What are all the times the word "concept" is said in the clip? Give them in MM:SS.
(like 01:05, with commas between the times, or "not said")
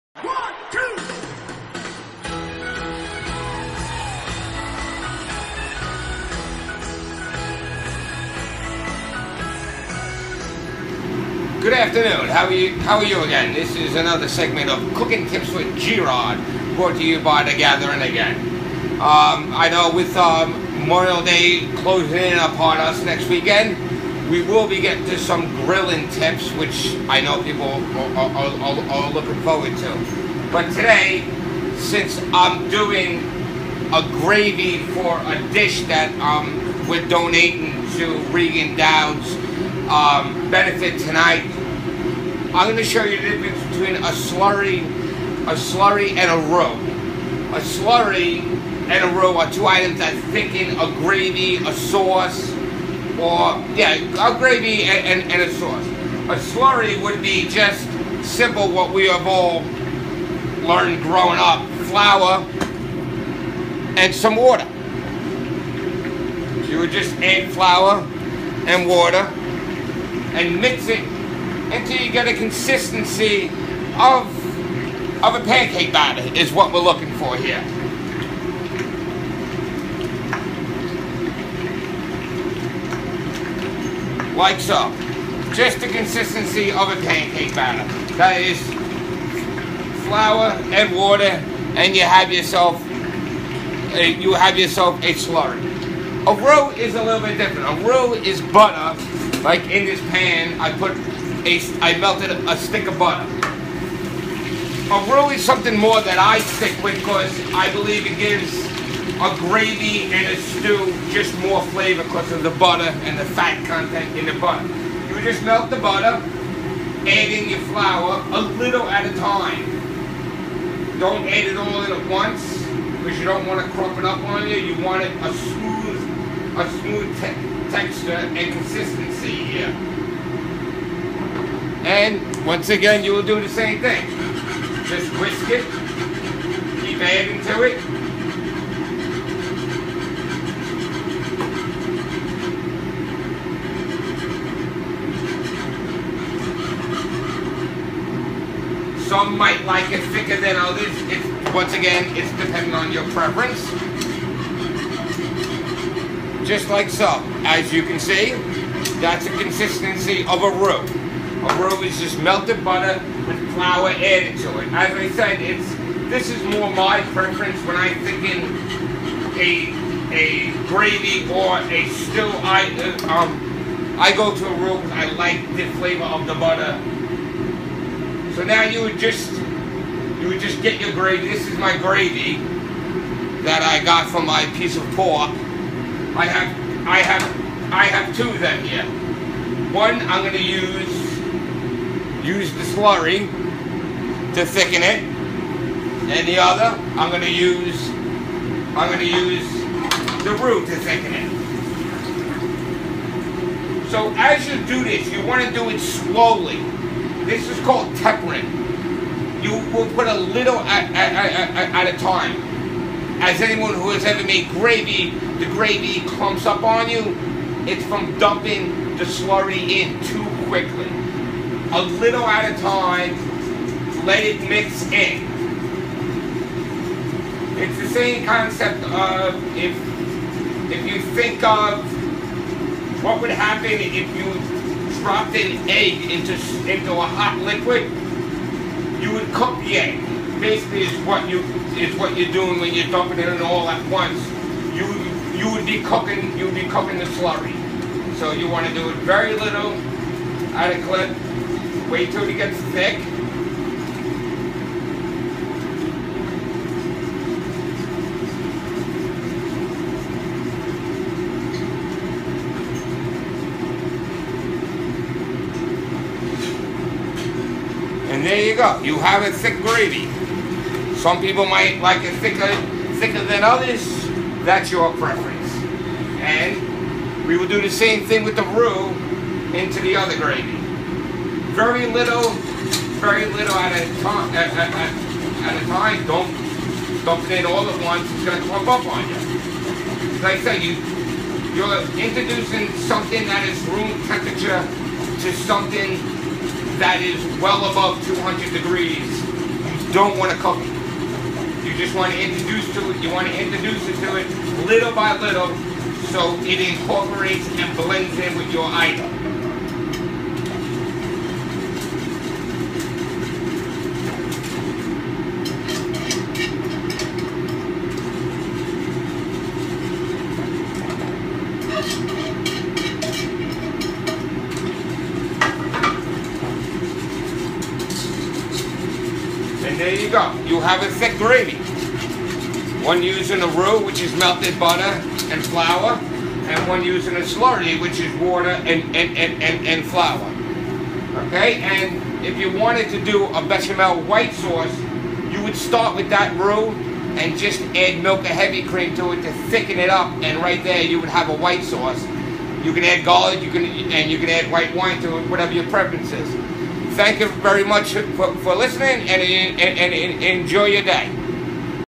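03:48.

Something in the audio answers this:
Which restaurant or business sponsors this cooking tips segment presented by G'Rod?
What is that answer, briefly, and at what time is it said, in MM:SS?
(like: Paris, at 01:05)
The Gather Inn, at 00:17.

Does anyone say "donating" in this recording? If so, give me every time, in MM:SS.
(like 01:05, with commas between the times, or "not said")
00:37.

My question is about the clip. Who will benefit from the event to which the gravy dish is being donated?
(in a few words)
Regan Downs.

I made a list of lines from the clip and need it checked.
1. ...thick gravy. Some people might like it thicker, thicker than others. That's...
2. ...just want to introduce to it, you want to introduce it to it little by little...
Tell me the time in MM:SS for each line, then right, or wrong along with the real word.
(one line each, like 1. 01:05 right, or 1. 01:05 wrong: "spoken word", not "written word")
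1. 04:29 right
2. 05:01 right.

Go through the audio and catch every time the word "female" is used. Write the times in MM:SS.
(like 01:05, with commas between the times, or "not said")
not said.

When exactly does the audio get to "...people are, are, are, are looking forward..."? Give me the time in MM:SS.
00:27.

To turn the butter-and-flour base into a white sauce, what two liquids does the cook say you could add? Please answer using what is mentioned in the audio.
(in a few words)
milk or heavy cream.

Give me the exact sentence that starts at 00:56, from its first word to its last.
A slurry would be just simple what we have all learned growing up: flour and some water.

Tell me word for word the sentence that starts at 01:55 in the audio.
You just melt the butter, add in your flour a little at a time.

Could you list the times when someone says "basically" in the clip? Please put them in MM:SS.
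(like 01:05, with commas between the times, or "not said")
04:00.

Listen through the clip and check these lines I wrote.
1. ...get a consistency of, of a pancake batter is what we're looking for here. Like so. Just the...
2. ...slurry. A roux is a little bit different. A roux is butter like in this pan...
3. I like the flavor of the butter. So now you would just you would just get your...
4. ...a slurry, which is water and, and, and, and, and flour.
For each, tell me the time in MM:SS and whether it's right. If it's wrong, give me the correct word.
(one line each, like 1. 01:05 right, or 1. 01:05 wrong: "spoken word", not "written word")
1. 01:12 right
2. 01:35 right
3. 02:54 right
4. 05:37 right.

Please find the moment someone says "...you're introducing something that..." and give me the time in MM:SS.
04:51.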